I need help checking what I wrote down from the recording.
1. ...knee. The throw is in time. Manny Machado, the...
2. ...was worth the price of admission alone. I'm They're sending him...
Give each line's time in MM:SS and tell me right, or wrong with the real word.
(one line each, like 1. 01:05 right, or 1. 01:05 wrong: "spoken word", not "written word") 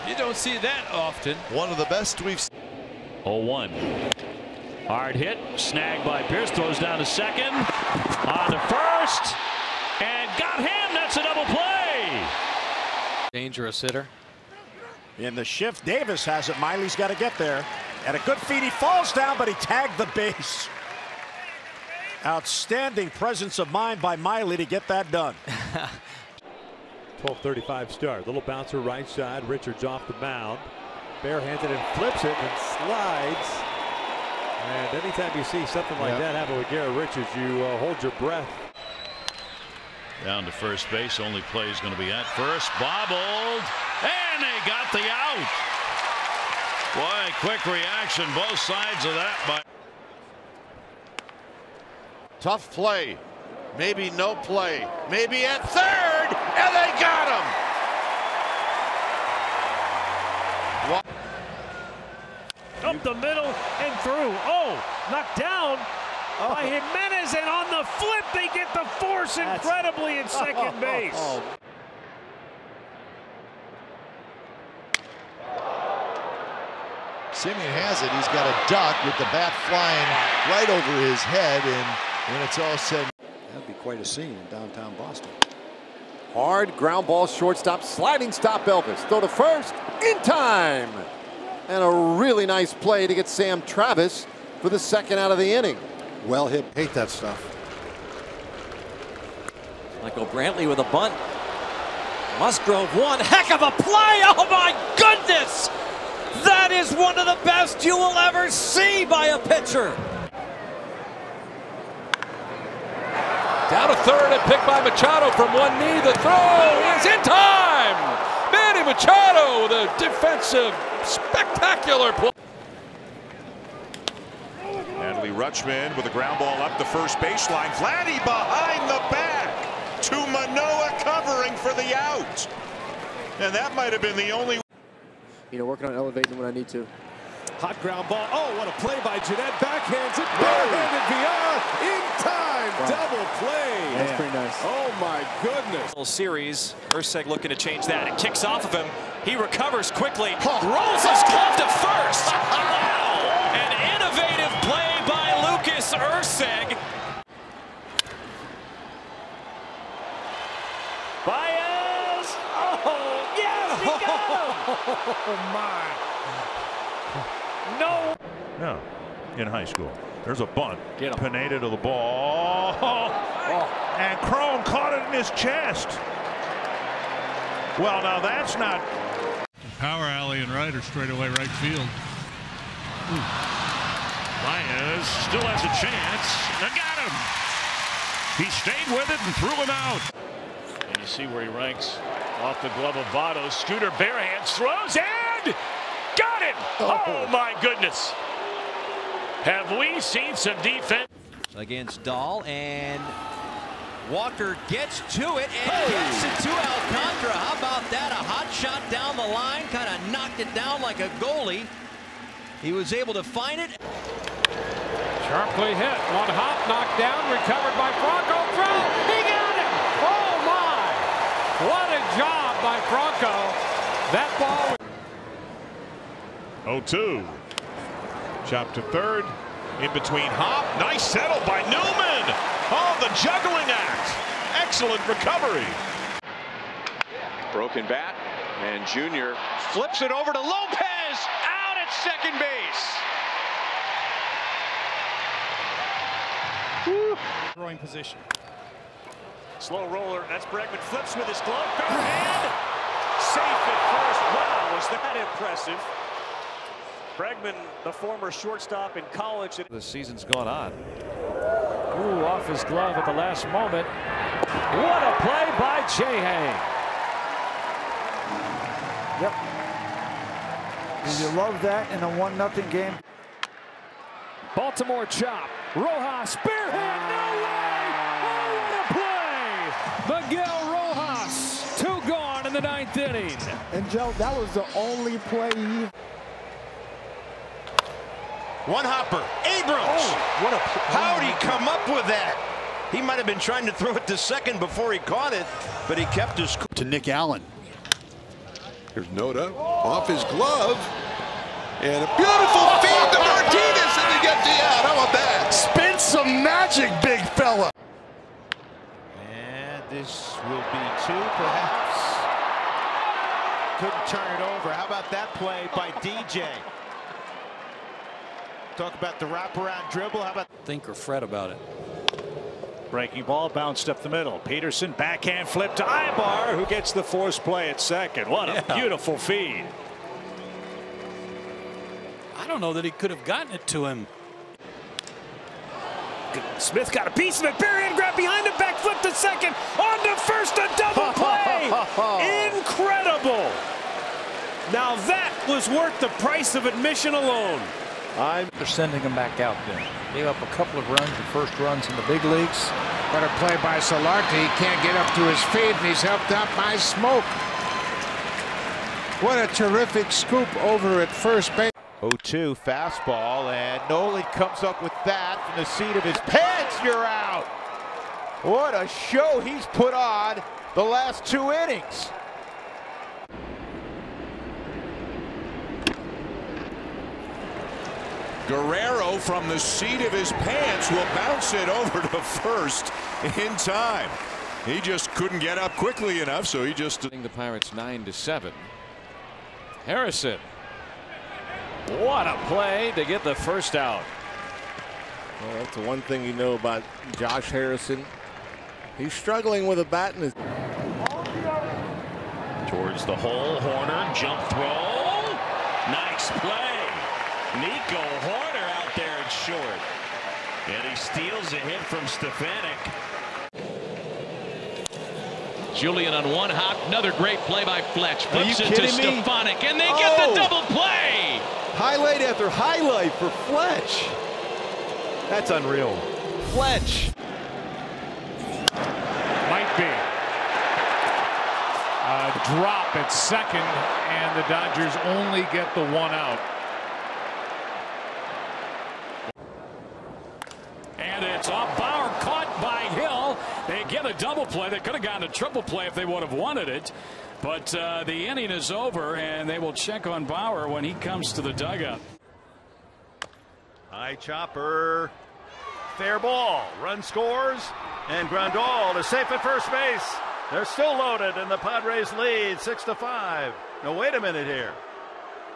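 1. 01:55 right
2. 05:45 right.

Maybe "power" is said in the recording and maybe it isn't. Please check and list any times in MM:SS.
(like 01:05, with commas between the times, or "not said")
02:59.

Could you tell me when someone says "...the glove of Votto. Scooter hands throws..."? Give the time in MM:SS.
03:12.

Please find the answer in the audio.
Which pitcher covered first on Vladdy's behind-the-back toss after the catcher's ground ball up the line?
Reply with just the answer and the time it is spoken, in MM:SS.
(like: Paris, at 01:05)
Manoah, at 02:10.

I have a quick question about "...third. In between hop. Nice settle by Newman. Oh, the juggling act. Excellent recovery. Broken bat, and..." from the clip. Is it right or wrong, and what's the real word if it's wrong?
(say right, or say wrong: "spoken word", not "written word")
right.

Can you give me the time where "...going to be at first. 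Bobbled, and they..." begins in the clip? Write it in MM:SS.
00:41.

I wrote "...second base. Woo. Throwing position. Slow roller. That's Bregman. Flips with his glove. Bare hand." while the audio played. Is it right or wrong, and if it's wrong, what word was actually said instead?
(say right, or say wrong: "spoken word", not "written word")
right.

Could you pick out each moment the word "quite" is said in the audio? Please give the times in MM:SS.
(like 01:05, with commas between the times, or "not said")
01:23.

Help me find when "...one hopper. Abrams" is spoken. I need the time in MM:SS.
04:48.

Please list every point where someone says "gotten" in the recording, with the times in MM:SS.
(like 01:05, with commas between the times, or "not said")
05:33, 07:25.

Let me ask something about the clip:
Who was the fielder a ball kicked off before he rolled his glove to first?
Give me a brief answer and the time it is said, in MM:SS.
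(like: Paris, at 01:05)
Lucas Urseg, at 02:35.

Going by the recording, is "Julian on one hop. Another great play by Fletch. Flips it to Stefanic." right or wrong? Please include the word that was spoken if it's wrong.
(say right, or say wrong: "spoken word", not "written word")
right.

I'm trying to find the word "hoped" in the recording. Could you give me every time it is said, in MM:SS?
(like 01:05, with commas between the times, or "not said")
not said.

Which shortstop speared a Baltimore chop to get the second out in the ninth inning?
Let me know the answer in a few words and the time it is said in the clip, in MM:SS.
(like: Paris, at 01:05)
Miguel Rojas, at 04:40.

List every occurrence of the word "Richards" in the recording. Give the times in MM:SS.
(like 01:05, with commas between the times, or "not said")
00:29, 00:36.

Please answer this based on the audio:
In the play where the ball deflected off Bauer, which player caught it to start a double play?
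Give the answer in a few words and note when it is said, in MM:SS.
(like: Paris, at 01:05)
Hill, at 07:22.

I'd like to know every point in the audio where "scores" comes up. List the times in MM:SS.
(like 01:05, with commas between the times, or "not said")
07:37.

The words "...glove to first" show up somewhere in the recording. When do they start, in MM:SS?
02:31.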